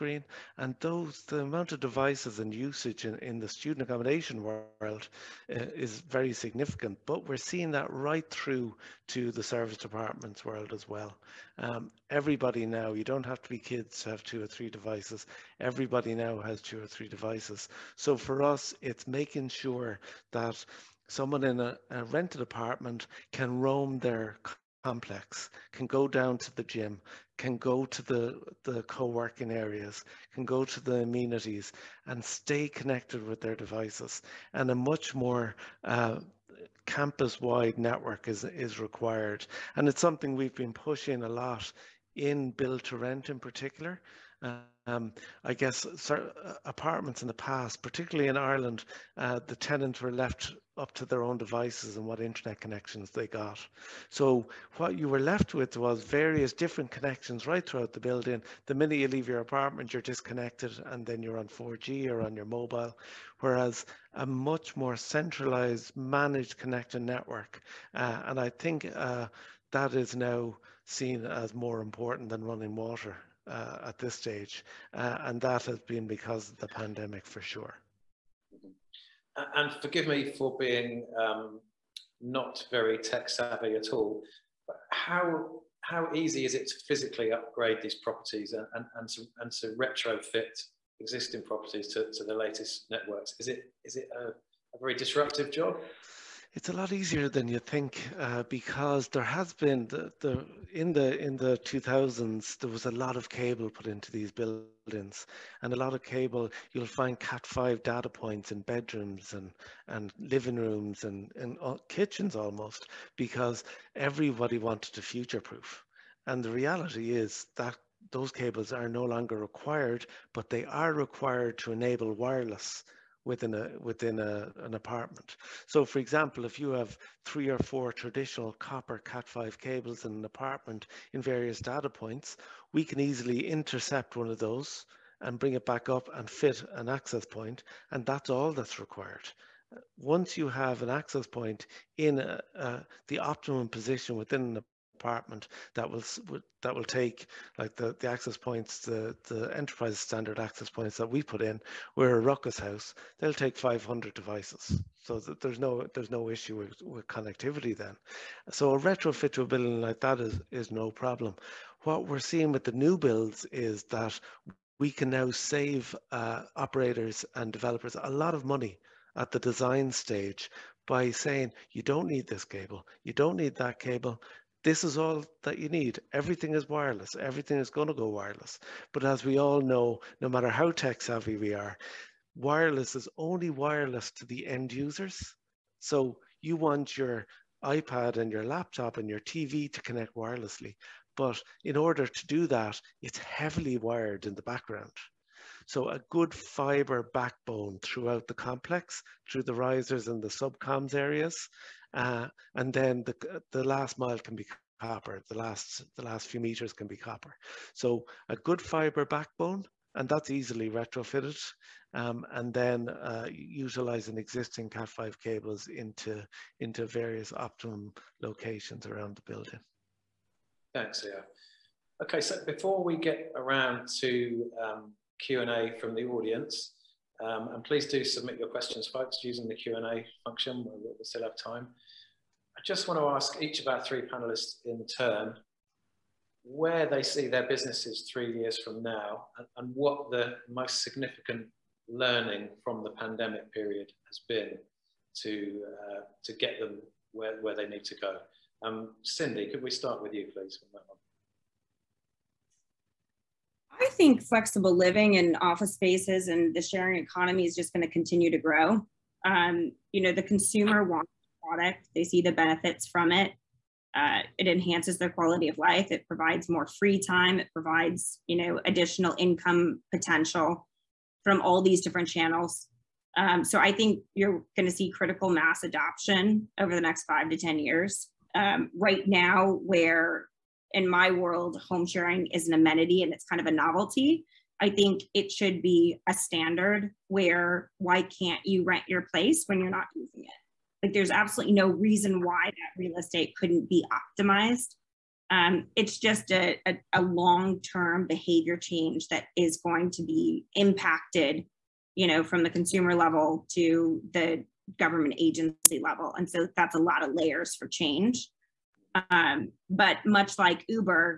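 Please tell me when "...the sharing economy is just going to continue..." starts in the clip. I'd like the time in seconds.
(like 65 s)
256 s.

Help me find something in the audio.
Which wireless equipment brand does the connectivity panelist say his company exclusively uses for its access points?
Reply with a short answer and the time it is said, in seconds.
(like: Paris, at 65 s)
Ruckus, at 152 s.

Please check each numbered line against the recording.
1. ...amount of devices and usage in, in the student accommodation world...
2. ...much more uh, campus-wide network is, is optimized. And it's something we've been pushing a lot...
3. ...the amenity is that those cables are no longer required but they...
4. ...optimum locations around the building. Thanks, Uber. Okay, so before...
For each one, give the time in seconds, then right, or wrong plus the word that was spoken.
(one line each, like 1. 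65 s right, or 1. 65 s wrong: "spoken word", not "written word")
1. 1 s right
2. 34 s wrong: "required", not "optimized"
3. 116 s wrong: "reality", not "amenity"
4. 217 s wrong: "Leo", not "Uber".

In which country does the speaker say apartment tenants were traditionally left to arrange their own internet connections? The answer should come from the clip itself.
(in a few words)
Ireland.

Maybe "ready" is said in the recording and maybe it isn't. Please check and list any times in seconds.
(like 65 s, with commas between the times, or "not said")
not said.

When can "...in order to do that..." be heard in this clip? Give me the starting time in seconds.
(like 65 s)
191 s.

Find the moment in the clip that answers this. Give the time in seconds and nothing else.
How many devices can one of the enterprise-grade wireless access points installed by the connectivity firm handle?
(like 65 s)
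153 s.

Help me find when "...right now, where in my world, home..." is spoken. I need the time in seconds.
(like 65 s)
278 s.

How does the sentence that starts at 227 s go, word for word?
Um, and please do submit your questions, folks, using the Q&A function.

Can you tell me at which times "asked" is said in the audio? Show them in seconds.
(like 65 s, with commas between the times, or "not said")
not said.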